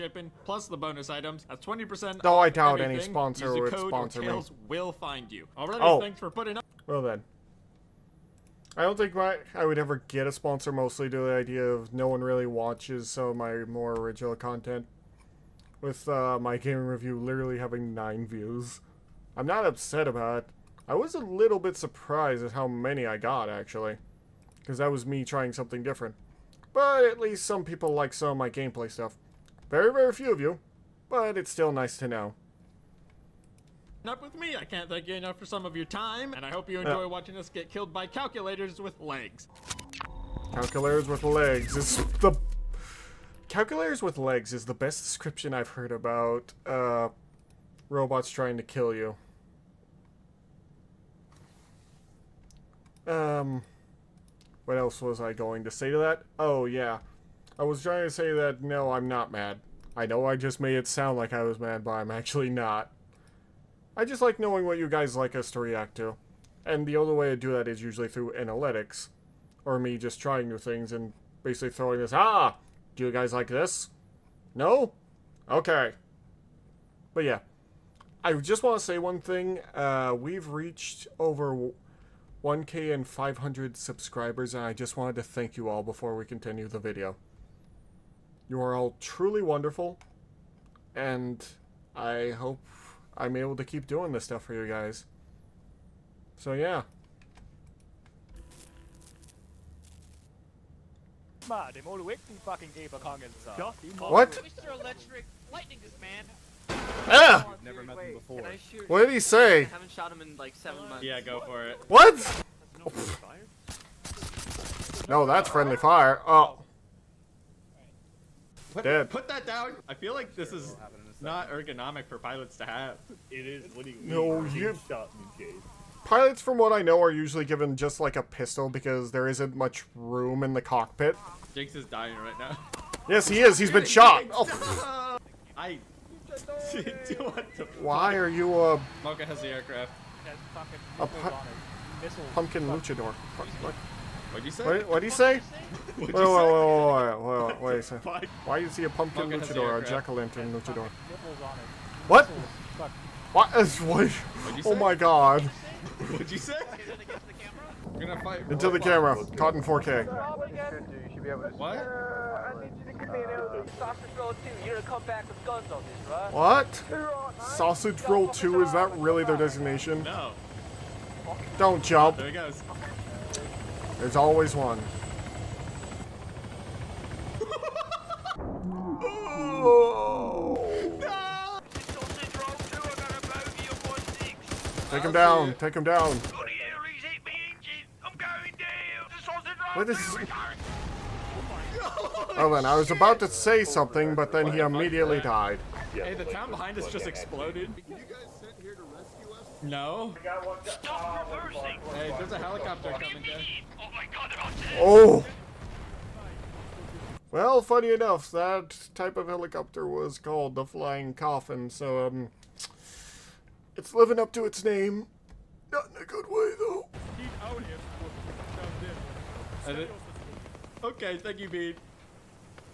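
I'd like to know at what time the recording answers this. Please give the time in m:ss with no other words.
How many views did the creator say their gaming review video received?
0:17.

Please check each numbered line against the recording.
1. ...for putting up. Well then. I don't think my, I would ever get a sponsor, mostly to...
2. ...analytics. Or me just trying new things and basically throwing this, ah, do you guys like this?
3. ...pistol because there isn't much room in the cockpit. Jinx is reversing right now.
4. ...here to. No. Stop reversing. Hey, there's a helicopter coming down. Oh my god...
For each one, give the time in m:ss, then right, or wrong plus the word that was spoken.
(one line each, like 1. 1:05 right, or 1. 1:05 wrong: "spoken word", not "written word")
1. 0:06 right
2. 1:08 right
3. 2:08 wrong: "dying", not "reversing"
4. 3:18 right.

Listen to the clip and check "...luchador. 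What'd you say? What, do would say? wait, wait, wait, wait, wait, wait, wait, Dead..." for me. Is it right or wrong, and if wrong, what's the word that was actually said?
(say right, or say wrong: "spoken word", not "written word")
wrong: "Why", not "Dead".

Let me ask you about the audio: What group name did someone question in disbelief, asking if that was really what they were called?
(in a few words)
Sausage Roll 2.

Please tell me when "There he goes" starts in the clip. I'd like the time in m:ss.
2:52.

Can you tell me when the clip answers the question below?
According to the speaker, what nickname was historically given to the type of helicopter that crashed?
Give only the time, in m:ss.
3:30.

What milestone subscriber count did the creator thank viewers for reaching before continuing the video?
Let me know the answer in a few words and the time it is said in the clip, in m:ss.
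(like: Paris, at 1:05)
1,500, at 1:22.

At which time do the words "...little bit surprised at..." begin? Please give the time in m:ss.
0:21.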